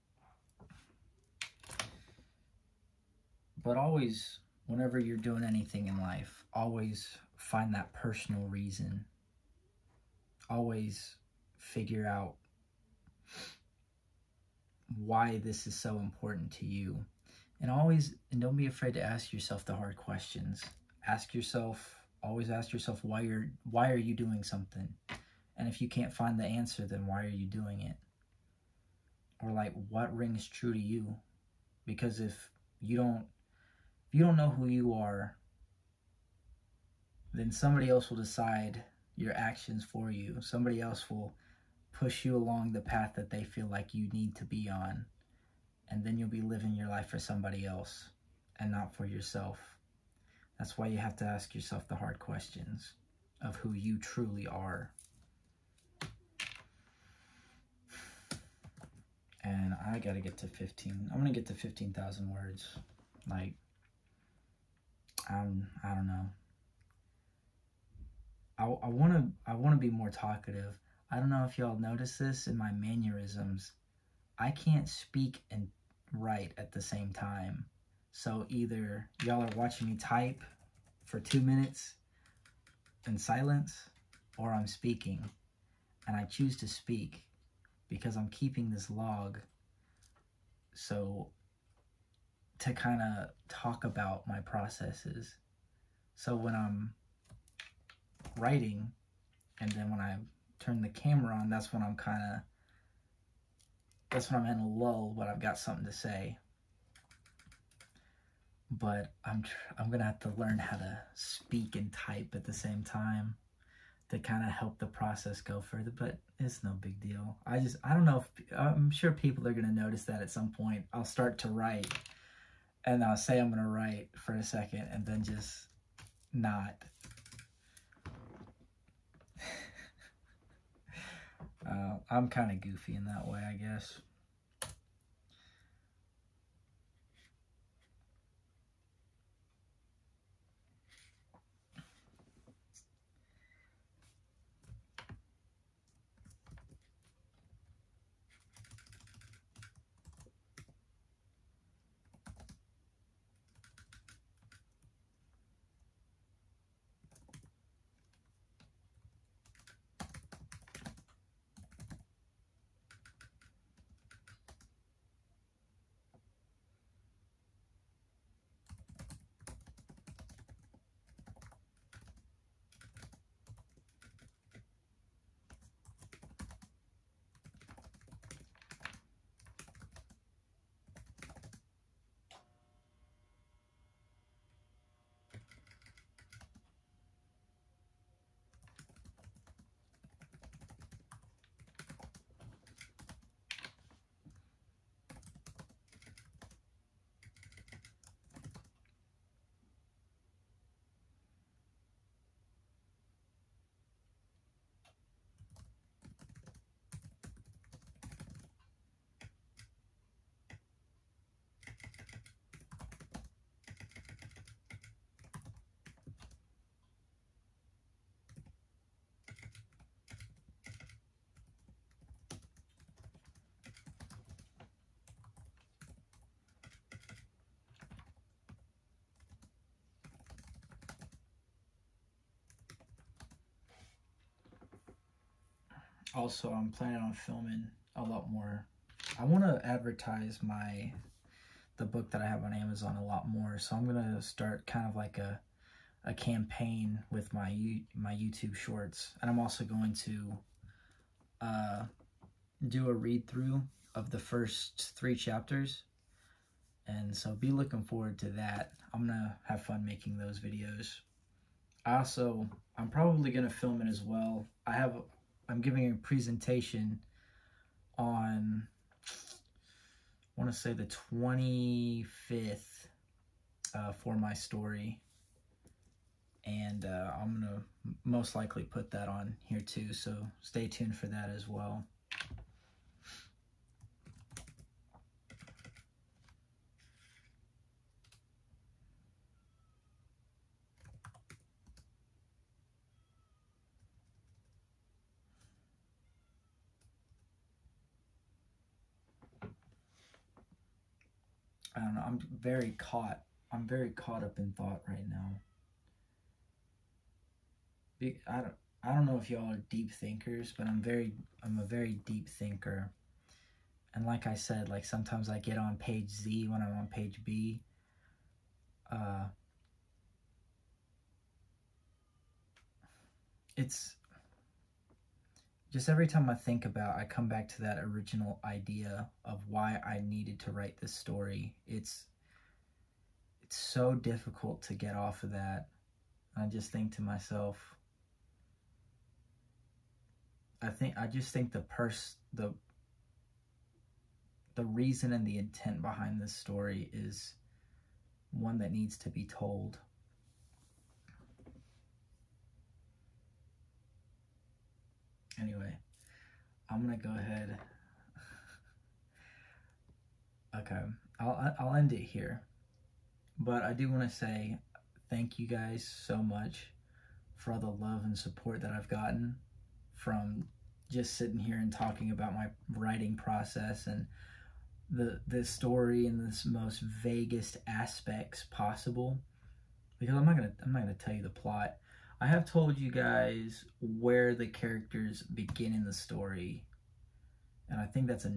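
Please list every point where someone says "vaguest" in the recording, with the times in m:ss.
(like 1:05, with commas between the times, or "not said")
6:17.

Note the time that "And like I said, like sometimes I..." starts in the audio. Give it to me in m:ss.
5:13.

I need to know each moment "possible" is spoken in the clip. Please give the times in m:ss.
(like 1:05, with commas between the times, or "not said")
6:18.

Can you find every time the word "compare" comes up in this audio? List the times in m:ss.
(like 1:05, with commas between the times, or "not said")
not said.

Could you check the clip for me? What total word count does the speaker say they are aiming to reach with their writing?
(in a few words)
15,000.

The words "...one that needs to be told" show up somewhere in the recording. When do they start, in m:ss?
5:48.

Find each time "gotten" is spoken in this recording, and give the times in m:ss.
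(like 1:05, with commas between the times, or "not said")
6:08.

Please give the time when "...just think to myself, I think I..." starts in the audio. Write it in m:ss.
5:36.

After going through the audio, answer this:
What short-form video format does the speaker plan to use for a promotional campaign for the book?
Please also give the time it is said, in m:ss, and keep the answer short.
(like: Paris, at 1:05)
YouTube shorts, at 4:08.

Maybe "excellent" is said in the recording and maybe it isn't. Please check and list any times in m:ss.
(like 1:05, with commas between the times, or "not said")
not said.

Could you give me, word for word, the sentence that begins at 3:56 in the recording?
also I'm planning on filming a lot more.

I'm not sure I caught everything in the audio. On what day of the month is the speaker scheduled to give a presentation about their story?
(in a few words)
25th.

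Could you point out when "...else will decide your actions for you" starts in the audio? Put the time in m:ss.
0:37.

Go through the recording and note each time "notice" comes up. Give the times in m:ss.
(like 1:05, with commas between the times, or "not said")
1:11, 1:59.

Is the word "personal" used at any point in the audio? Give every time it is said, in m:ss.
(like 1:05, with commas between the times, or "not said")
0:07.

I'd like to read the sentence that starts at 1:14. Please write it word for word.
I can't speak and write at the same time.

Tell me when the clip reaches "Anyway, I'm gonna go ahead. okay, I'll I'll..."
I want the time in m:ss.
5:55.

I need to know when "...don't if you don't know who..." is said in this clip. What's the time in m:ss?
0:32.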